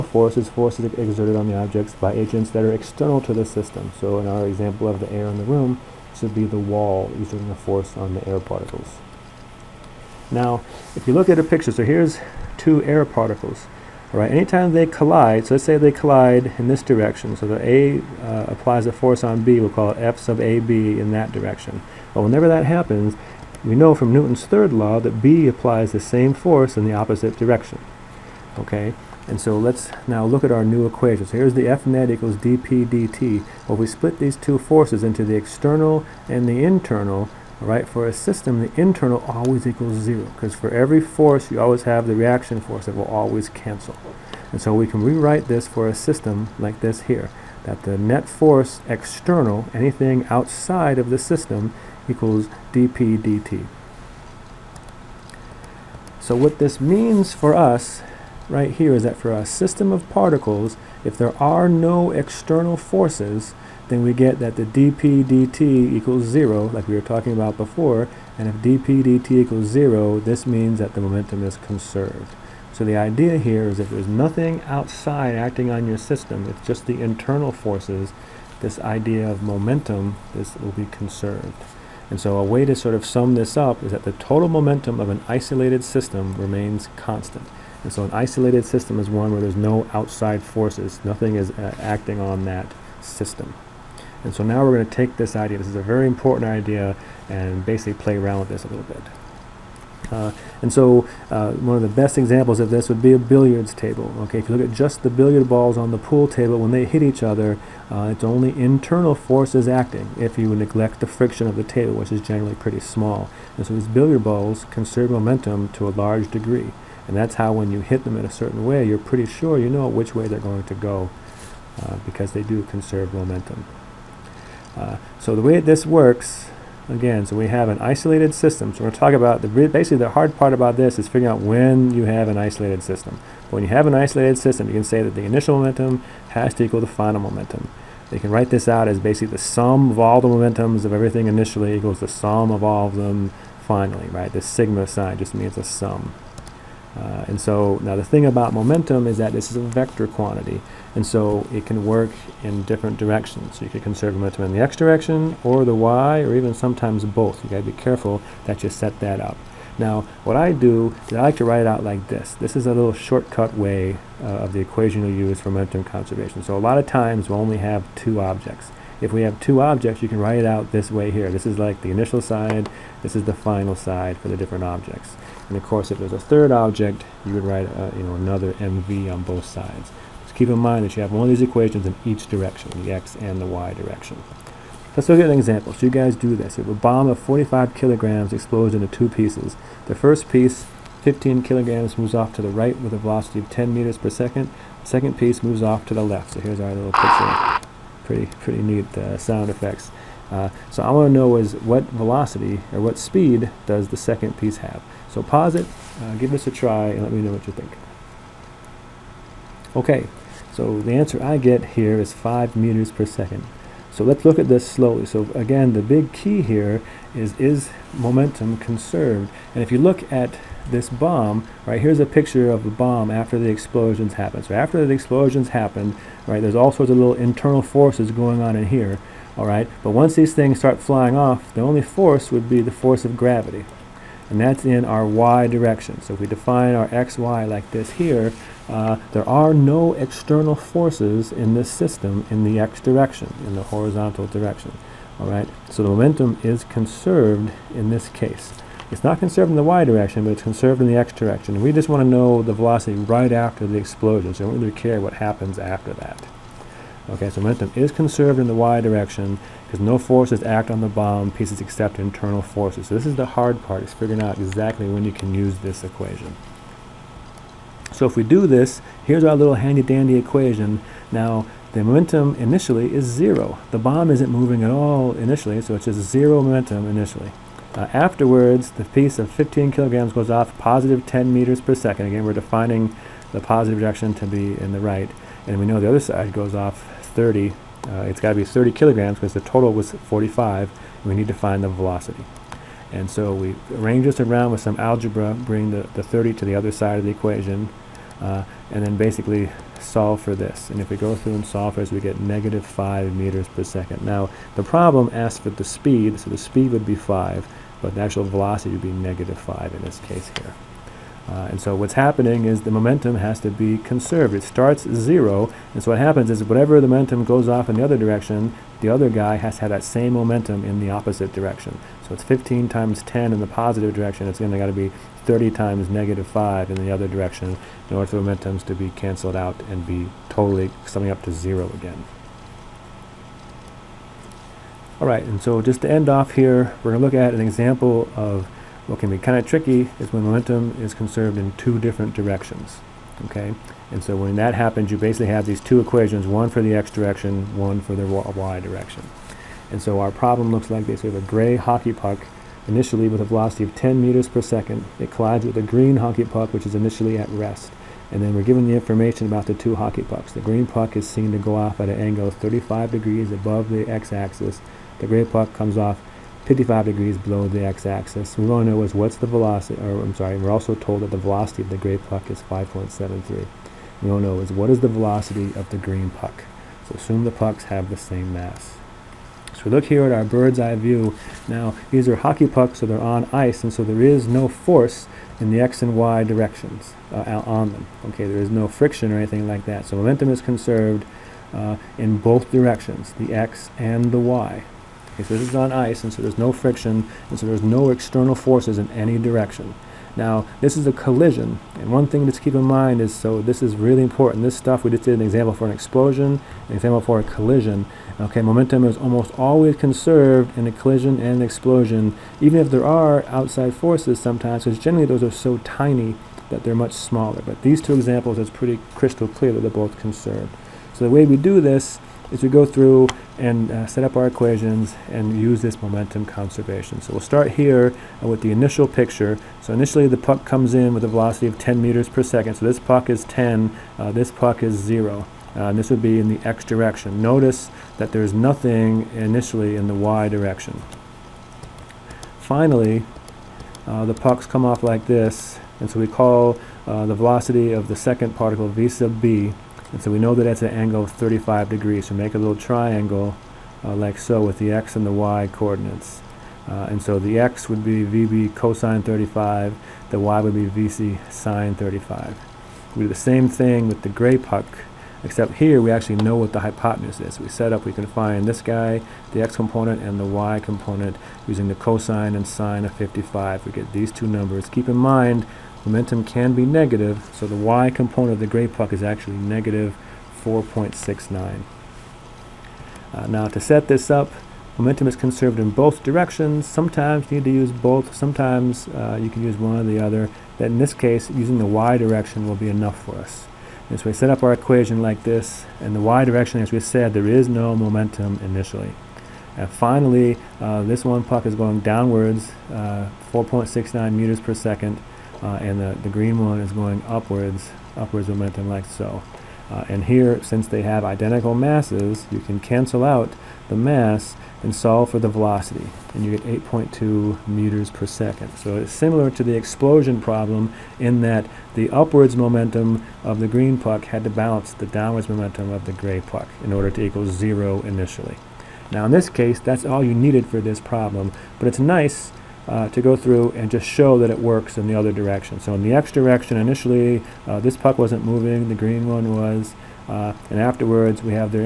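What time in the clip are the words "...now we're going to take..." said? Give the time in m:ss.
1:34.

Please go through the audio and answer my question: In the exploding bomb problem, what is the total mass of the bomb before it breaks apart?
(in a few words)
45 kilograms.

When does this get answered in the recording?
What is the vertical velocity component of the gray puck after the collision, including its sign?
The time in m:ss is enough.
7:59.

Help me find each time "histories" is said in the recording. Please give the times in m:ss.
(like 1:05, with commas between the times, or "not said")
not said.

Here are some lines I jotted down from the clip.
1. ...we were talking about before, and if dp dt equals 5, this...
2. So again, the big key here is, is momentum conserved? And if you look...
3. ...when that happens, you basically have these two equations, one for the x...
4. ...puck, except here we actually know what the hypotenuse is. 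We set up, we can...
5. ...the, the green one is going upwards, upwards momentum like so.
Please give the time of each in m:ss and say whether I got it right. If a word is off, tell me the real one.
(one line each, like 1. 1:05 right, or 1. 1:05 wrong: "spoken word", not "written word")
1. 1:06 wrong: "0", not "5"
2. 3:35 right
3. 5:44 right
4. 7:44 right
5. 8:25 right.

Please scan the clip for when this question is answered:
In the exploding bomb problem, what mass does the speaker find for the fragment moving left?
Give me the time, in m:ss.
4:48.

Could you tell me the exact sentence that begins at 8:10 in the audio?
That in this case, using the y direction will be enough for us.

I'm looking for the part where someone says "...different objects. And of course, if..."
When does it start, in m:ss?
2:54.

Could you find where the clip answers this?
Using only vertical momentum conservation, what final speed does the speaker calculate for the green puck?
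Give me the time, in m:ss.
8:36.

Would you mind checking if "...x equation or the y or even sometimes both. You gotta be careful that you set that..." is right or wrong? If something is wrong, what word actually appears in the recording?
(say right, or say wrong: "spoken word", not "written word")
wrong: "direction", not "equation".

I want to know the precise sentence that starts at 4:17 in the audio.
Okay, so momentum is conserved in the y direction because no forces act on the bomb pieces except internal forces.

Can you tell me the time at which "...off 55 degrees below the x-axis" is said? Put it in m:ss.
6:05.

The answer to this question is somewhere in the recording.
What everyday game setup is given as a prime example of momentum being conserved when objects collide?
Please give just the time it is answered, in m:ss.
1:43.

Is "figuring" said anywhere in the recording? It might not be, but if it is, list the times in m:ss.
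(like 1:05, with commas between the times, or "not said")
2:11, 4:23.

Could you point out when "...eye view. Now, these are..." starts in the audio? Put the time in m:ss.
6:20.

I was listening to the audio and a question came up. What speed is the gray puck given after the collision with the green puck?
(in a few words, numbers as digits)
5.73.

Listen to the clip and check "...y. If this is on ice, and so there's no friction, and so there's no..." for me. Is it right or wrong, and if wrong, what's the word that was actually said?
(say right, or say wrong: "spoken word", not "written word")
right.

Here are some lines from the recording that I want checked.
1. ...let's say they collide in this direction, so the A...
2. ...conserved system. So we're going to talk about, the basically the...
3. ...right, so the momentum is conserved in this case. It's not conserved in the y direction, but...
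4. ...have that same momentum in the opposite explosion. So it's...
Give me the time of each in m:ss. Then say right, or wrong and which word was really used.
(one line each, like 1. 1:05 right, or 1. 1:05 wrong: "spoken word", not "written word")
1. 0:15 right
2. 2:07 wrong: "isolated", not "conserved"
3. 4:05 right
4. 5:19 wrong: "direction", not "explosion".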